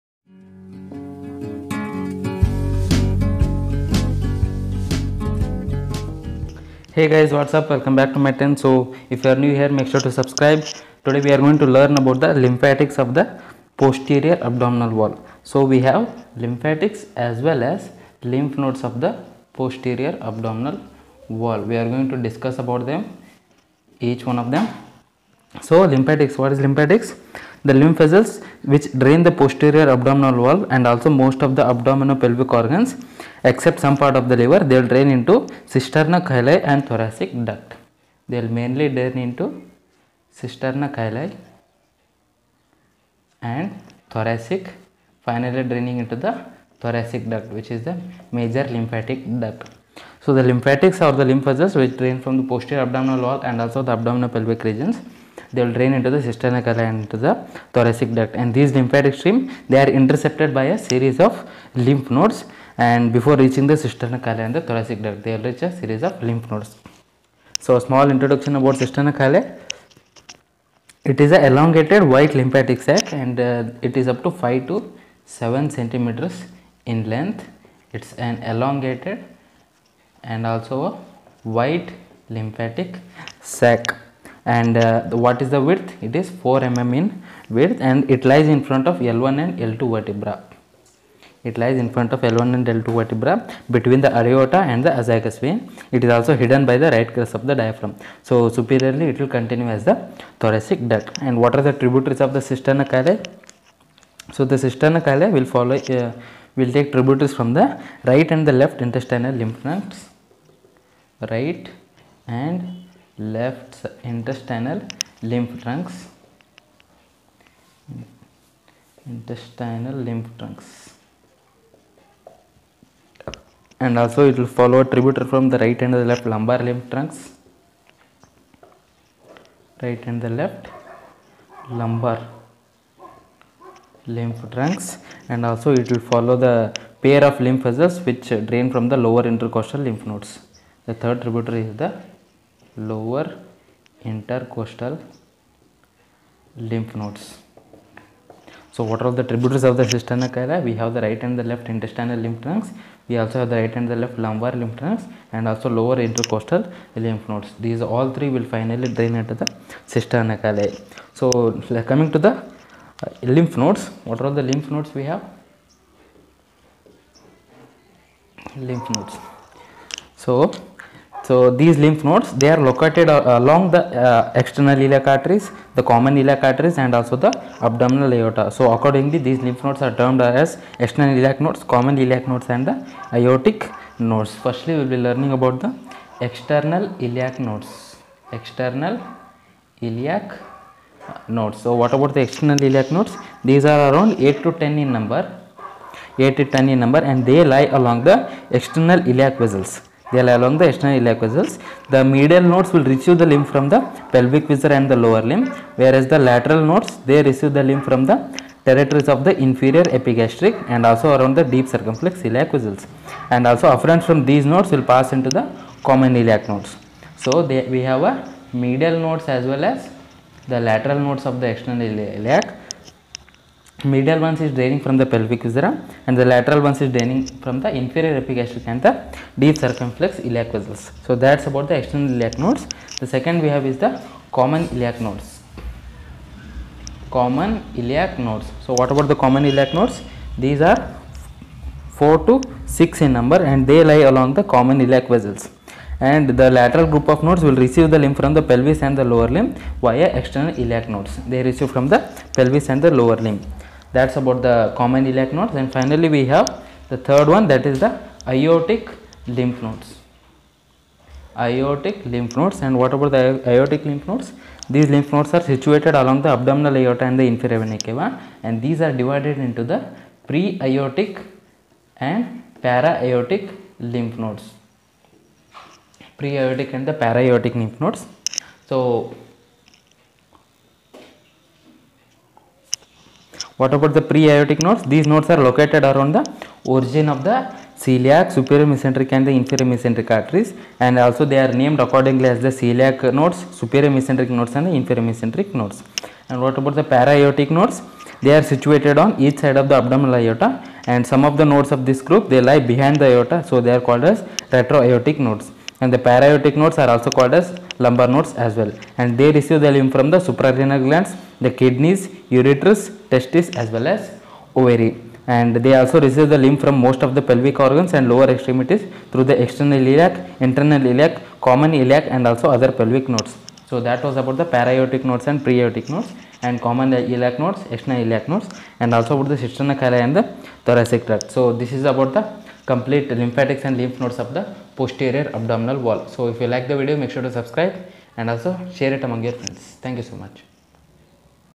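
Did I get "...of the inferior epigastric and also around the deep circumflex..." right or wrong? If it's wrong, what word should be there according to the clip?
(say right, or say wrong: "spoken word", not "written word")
right.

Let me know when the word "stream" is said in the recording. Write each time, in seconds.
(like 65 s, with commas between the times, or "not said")
59 s.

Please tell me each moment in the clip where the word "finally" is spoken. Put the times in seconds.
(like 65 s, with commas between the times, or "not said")
45 s, 158 s, 255 s.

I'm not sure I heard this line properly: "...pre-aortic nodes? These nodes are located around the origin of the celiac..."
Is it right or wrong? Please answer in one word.
right.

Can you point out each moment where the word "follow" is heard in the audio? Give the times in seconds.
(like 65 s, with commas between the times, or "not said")
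105 s, 124 s, 136 s.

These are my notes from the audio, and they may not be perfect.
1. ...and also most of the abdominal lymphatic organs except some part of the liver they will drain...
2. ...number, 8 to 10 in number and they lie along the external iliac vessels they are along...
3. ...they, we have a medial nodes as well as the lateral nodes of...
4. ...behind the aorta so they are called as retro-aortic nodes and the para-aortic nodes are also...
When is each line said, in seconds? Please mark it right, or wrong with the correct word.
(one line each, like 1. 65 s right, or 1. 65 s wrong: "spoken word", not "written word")
1. 30 s wrong: "pelvic", not "lymphatic"
2. 194 s right
3. 217 s right
4. 302 s right.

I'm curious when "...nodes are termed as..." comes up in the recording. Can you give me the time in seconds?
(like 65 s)
179 s.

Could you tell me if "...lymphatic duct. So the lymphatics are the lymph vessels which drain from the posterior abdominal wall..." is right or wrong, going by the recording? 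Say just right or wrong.
right.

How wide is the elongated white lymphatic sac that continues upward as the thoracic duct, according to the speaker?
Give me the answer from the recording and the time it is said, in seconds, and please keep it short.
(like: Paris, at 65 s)
4 mm, at 86 s.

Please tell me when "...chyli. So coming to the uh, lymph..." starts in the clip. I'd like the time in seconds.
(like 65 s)
160 s.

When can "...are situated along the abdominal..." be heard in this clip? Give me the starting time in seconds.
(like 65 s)
265 s.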